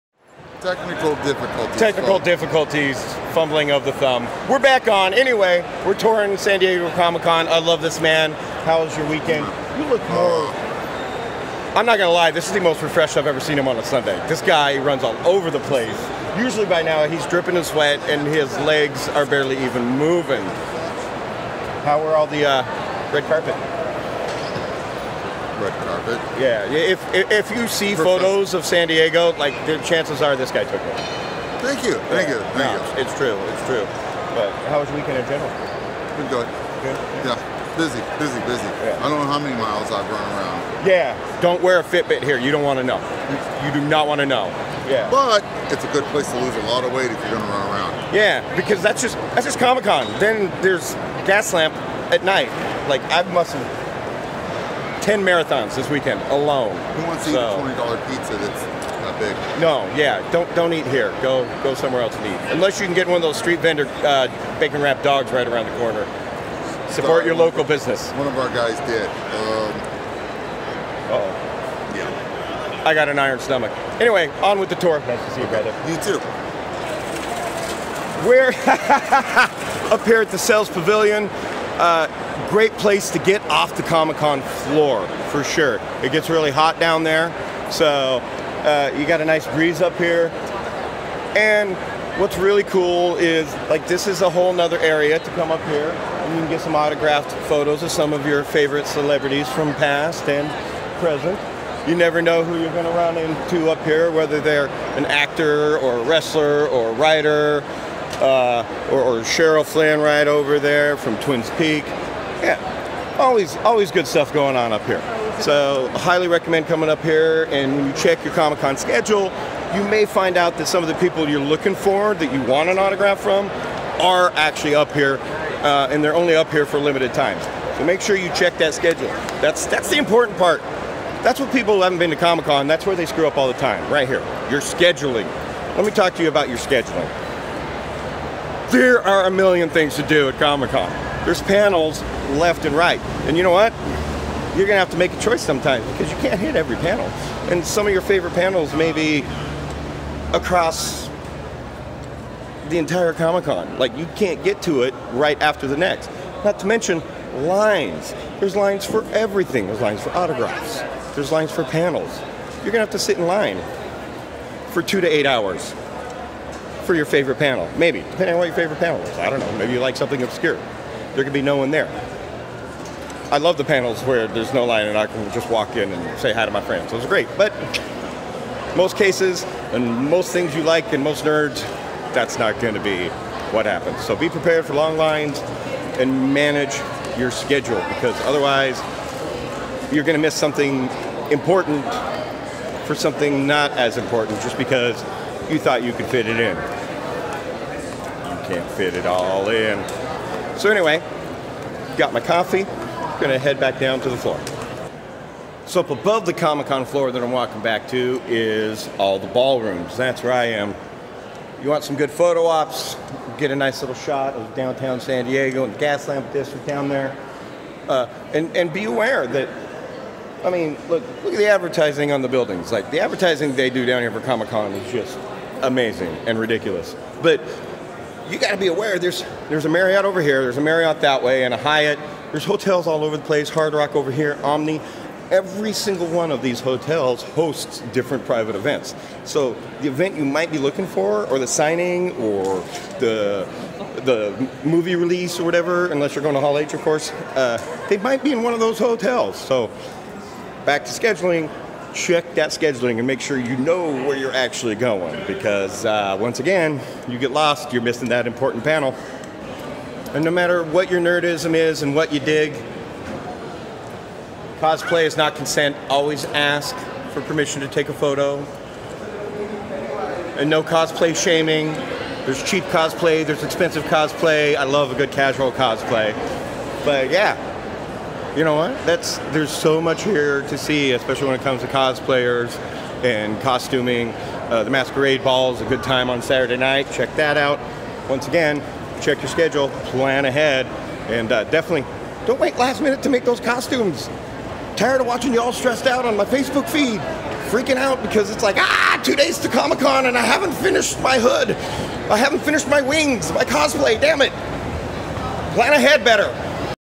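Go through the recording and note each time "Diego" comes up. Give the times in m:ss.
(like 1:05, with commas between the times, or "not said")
0:06, 0:28, 3:35.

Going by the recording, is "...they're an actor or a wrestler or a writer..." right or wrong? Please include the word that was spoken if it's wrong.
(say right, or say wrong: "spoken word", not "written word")
right.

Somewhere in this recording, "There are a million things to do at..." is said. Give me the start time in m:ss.
2:18.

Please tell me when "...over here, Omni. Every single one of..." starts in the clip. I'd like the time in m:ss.
3:53.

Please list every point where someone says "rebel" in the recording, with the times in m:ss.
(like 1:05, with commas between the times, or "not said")
not said.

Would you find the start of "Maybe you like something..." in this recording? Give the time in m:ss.
2:49.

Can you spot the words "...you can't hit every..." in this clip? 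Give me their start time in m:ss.
2:26.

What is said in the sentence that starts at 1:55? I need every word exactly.
So highly recommend coming up here.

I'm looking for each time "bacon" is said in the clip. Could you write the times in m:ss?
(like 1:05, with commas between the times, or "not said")
1:04.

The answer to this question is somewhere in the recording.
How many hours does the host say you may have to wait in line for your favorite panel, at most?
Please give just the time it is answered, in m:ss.
2:45.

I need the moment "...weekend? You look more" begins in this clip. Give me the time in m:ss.
0:09.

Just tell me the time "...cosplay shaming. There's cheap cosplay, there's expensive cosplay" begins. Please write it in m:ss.
4:30.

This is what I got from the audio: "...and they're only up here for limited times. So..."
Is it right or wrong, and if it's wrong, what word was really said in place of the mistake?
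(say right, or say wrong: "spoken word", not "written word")
right.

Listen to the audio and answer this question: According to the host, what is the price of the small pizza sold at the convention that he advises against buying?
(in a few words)
$20.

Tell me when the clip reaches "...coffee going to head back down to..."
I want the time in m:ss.
3:22.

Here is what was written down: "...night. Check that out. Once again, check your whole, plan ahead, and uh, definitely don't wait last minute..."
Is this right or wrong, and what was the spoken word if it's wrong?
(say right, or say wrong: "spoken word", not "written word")
wrong: "schedule", not "whole".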